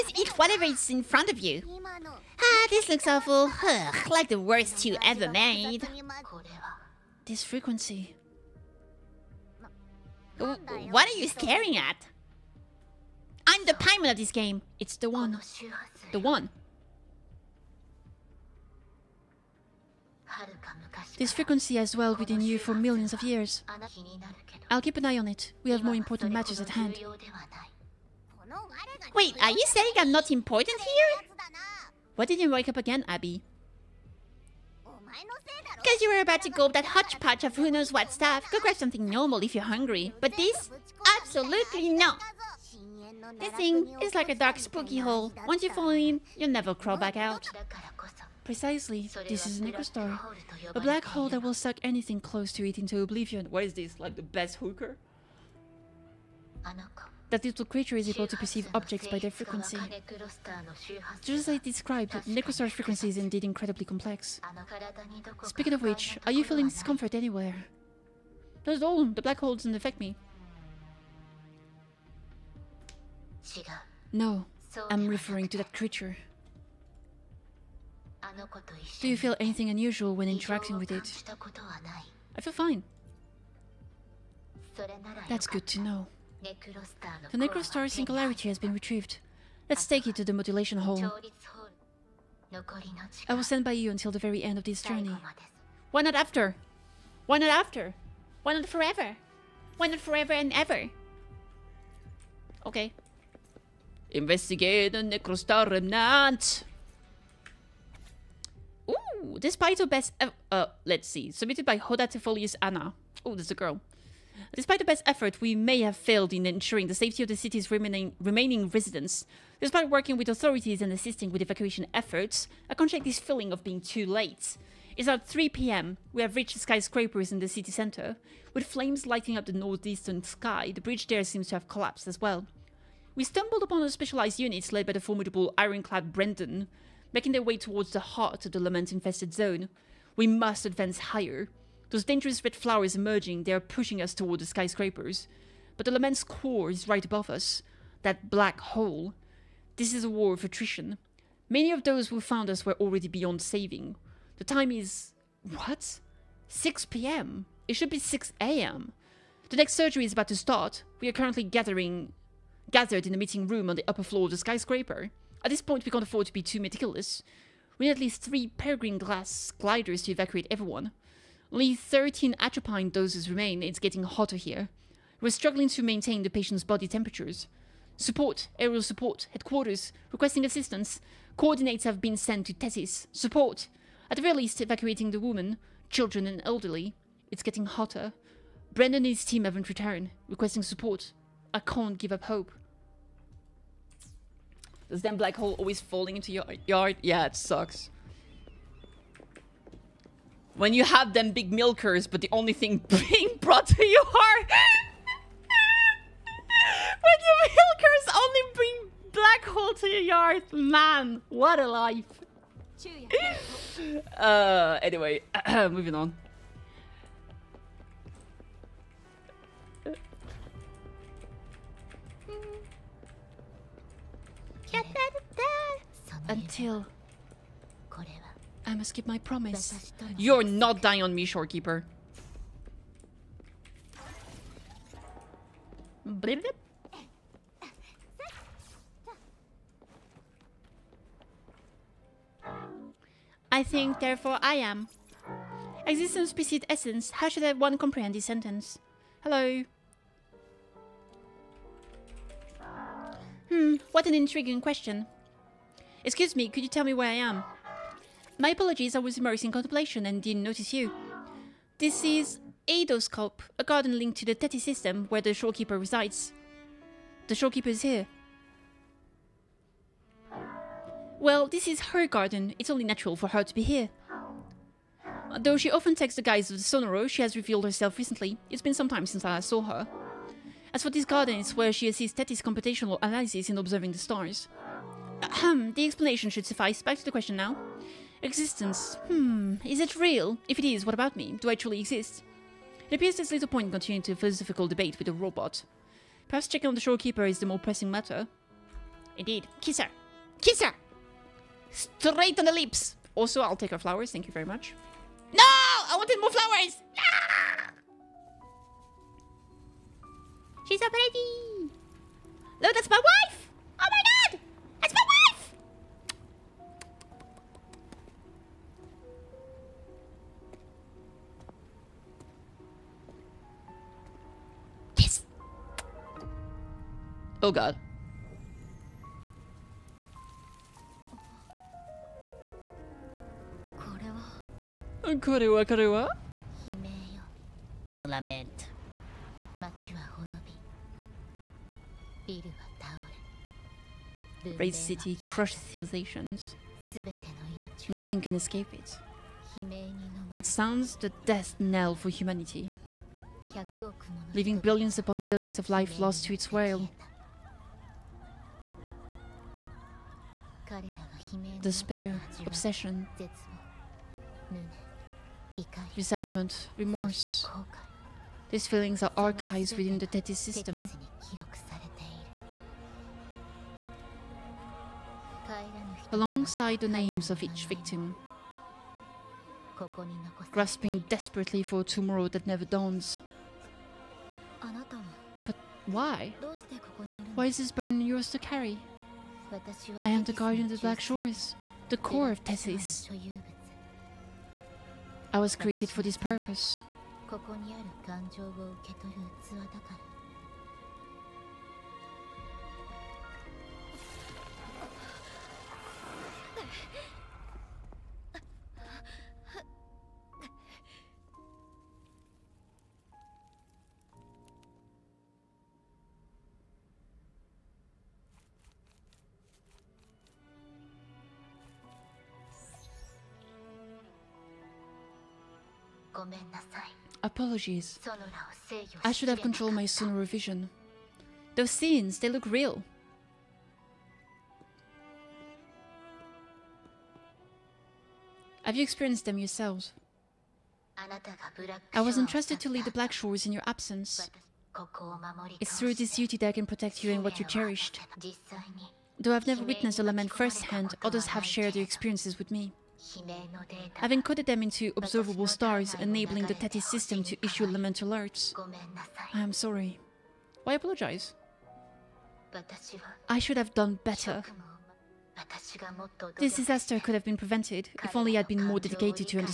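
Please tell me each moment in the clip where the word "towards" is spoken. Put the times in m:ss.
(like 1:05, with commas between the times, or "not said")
2:17, 2:24.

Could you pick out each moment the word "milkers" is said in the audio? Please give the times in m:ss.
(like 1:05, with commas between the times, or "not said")
3:21, 3:27.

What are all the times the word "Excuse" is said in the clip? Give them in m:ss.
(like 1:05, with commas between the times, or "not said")
4:16.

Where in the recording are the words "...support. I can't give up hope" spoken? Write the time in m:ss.
3:10.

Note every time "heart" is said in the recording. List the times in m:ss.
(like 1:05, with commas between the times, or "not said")
2:17.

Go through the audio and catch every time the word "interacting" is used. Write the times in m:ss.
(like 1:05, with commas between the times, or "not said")
1:20.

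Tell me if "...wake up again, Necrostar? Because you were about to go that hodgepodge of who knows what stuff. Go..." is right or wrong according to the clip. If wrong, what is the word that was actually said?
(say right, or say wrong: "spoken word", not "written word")
wrong: "Abby", not "Necrostar".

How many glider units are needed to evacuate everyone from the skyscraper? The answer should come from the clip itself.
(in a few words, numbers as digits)
3.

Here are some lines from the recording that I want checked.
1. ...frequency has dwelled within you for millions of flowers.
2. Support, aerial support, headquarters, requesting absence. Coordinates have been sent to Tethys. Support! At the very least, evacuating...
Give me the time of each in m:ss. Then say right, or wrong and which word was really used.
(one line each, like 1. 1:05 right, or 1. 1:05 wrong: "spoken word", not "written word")
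1. 0:21 wrong: "years", not "flowers"
2. 2:57 wrong: "assistance", not "absence".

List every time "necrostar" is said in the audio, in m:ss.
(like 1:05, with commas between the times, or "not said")
0:49, 1:02, 1:27, 1:44.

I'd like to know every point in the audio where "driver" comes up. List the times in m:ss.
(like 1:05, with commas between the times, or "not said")
not said.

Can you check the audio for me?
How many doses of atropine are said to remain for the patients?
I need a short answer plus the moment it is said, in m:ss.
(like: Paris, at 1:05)
13, at 2:51.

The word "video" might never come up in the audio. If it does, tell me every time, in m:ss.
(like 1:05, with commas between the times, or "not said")
not said.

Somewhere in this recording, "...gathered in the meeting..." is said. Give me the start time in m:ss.
2:42.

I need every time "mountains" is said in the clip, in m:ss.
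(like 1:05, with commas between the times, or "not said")
not said.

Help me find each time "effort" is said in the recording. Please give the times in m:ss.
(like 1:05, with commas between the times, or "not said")
1:55, 2:01.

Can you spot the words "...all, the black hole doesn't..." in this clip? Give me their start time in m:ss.
1:08.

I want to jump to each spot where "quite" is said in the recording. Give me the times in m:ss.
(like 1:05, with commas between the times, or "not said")
not said.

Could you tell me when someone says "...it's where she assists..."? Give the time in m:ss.
4:41.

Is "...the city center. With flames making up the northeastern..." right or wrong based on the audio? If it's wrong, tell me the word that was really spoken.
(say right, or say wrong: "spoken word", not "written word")
wrong: "lighting", not "making".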